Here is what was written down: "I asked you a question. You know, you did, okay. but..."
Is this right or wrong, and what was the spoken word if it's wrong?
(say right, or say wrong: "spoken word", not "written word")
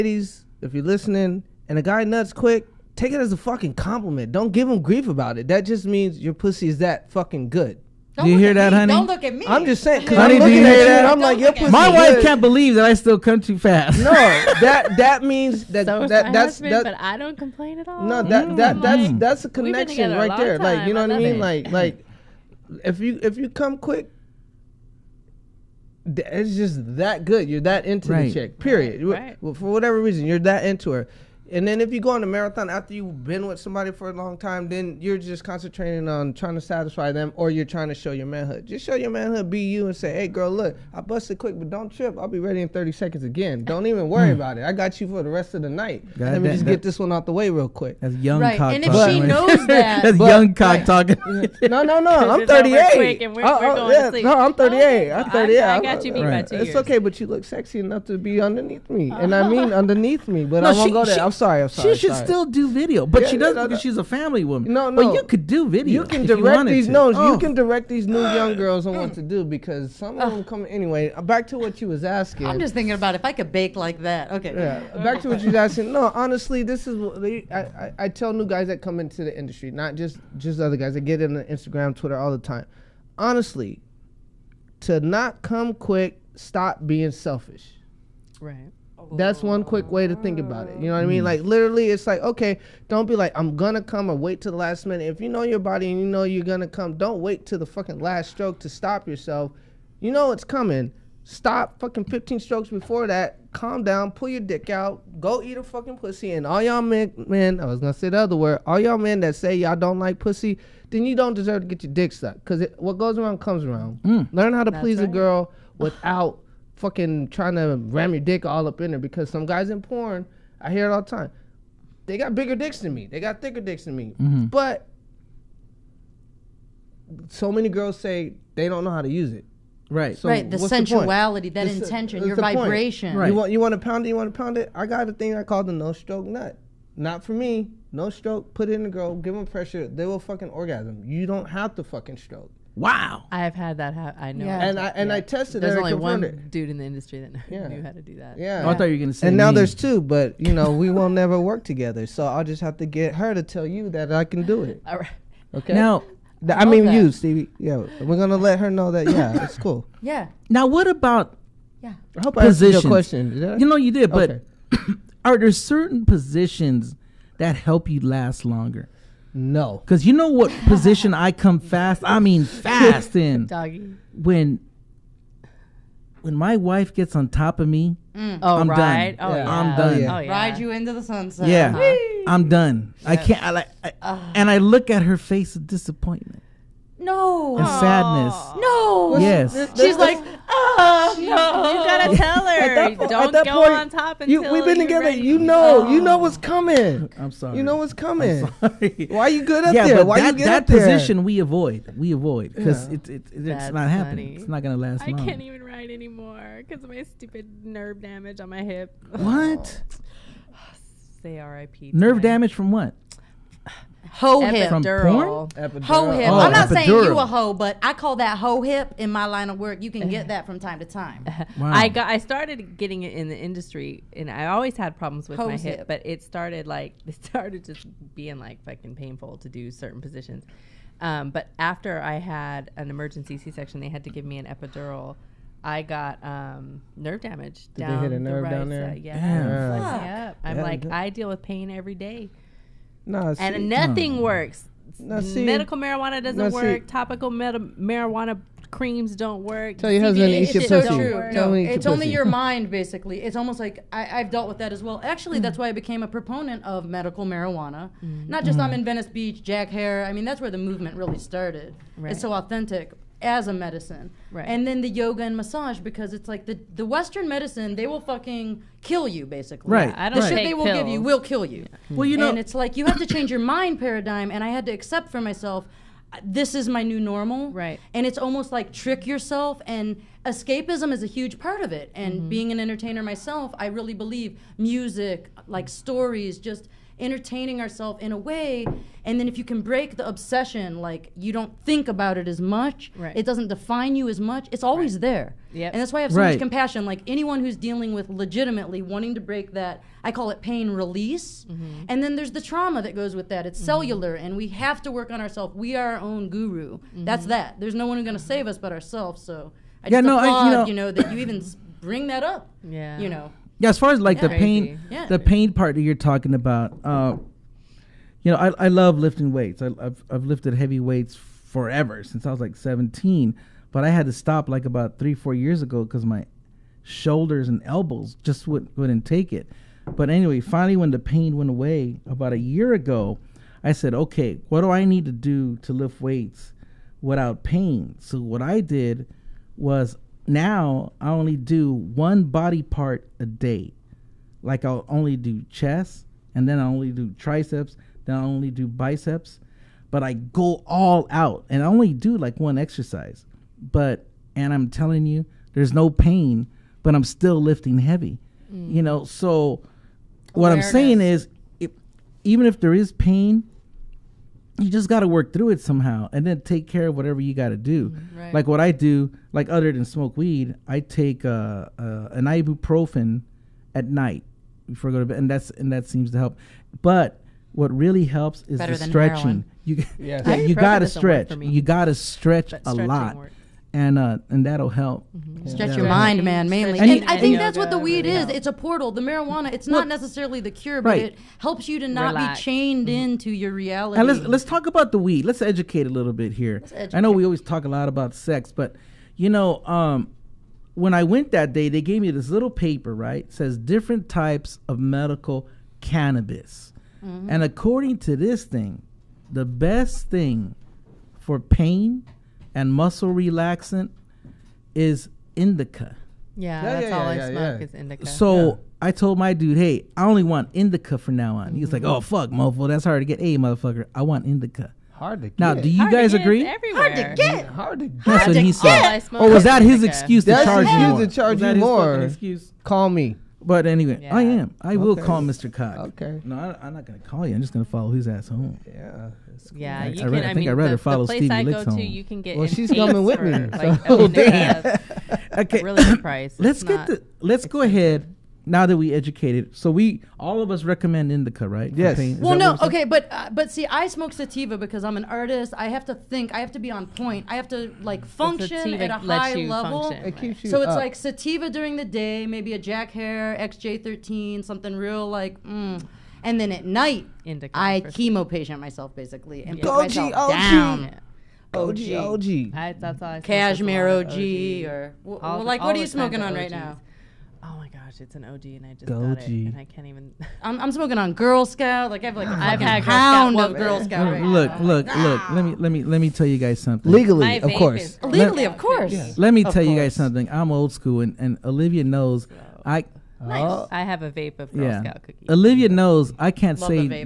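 right.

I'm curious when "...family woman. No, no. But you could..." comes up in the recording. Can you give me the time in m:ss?
1:04.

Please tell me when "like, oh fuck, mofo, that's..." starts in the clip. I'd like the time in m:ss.
7:01.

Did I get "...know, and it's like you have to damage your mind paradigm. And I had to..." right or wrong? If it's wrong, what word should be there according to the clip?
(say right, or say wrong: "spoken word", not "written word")
wrong: "change", not "damage".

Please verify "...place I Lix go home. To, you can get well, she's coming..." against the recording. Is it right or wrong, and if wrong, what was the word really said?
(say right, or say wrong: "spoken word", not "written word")
right.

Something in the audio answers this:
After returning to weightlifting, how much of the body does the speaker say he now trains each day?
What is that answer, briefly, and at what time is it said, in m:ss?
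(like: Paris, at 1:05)
One body part, at 5:41.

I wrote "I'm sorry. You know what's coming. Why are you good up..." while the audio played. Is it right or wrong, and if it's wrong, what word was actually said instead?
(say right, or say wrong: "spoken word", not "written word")
right.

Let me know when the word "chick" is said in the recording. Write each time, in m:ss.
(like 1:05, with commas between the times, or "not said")
0:28.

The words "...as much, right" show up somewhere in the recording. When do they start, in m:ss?
4:52.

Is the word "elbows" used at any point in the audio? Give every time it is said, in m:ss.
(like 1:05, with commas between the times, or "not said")
5:27.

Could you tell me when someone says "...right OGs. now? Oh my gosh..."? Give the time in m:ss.
7:56.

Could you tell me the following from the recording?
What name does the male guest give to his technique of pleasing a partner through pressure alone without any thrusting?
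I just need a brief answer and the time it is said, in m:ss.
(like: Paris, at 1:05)
no stroke nut, at 2:15.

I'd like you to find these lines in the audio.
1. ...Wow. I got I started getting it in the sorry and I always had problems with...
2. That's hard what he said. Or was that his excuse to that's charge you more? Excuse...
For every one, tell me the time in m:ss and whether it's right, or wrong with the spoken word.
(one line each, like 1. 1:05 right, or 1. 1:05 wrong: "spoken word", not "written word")
1. 3:41 wrong: "industry", not "sorry"
2. 7:08 right.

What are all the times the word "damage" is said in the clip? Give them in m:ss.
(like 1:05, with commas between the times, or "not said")
3:28, 3:32, 3:57.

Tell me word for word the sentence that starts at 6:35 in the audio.
Let's educate a little bit here.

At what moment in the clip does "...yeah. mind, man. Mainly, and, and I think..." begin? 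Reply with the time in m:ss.
6:25.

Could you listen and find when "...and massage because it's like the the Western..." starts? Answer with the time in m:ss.
4:25.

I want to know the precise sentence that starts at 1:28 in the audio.
Right that's one quick way to think about it.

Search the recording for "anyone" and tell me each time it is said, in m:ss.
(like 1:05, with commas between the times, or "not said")
4:57.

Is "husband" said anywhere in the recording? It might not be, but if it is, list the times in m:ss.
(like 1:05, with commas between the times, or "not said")
0:16, 4:10.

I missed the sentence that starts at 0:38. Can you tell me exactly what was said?
Just show your manhood, be you, and say, hey, girl, look, I busted quick, but don't trip.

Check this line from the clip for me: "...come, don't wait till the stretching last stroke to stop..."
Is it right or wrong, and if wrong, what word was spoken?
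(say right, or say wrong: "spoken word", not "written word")
wrong: "fucking", not "stretching".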